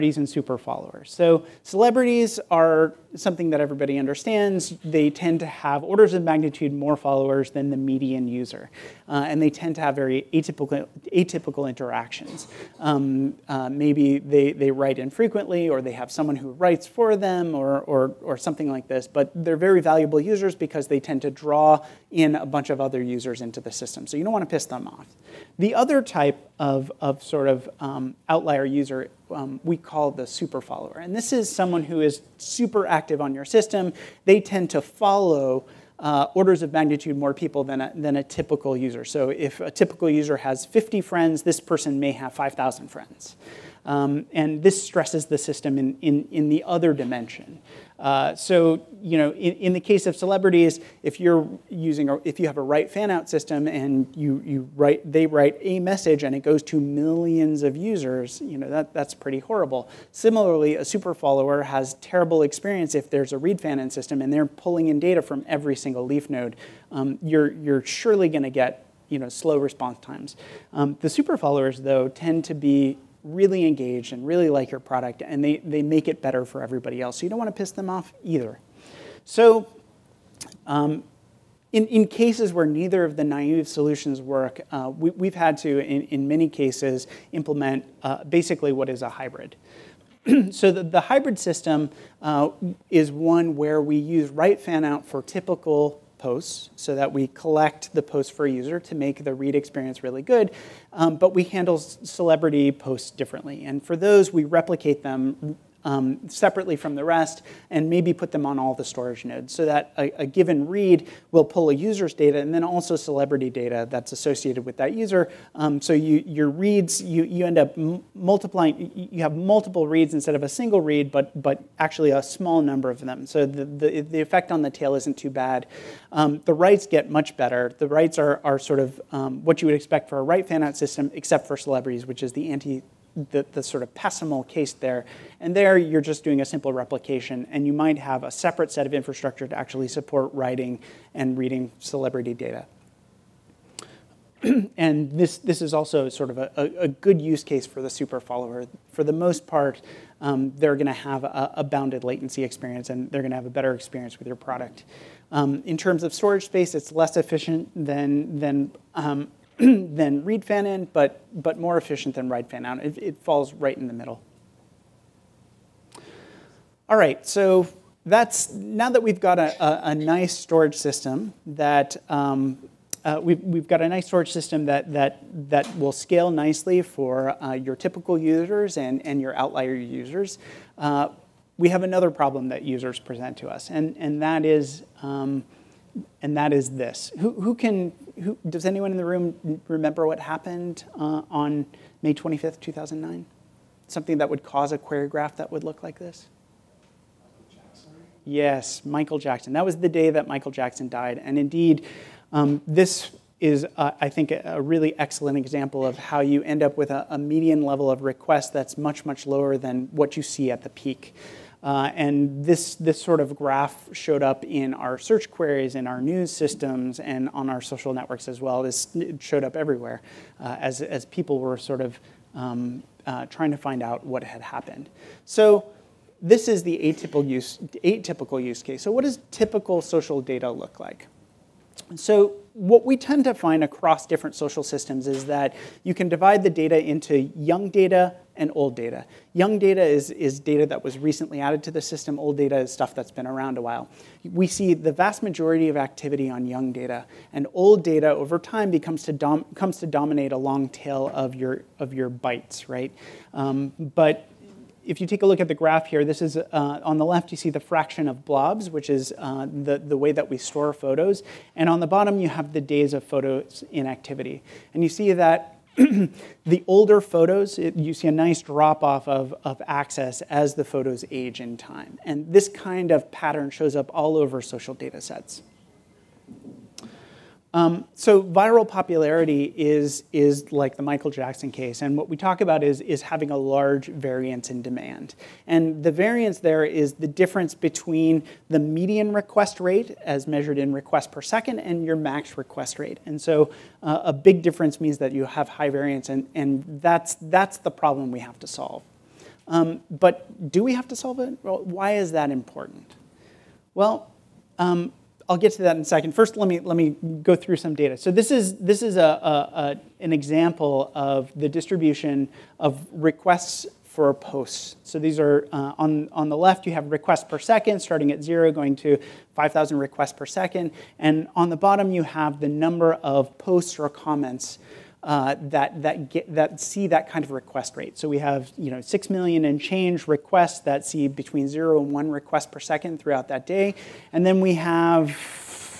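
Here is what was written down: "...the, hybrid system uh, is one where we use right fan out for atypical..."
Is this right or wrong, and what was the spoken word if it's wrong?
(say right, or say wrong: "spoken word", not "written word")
wrong: "typical", not "atypical".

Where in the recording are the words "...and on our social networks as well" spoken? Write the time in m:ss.
3:36.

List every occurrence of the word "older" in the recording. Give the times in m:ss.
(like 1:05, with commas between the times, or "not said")
4:26.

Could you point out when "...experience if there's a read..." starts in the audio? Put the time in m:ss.
1:02.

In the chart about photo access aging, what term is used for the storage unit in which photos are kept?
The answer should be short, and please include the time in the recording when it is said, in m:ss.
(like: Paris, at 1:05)
blobs, at 4:18.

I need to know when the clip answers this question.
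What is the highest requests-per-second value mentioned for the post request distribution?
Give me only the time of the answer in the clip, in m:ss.
5:19.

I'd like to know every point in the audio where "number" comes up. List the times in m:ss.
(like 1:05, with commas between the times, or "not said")
2:02, 5:22.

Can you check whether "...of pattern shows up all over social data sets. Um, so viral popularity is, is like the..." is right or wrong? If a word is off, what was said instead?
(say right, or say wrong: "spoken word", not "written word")
right.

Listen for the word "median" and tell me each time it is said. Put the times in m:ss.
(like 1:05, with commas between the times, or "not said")
0:07, 3:27, 4:48.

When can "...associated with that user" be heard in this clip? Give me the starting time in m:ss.
1:54.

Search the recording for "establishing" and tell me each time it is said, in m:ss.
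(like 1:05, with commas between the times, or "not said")
not said.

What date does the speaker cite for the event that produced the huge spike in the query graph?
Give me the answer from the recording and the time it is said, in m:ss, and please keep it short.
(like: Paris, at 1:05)
May 25th, 2009, at 3:12.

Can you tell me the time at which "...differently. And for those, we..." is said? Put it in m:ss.
1:43.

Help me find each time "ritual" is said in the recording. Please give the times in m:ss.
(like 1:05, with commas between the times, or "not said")
not said.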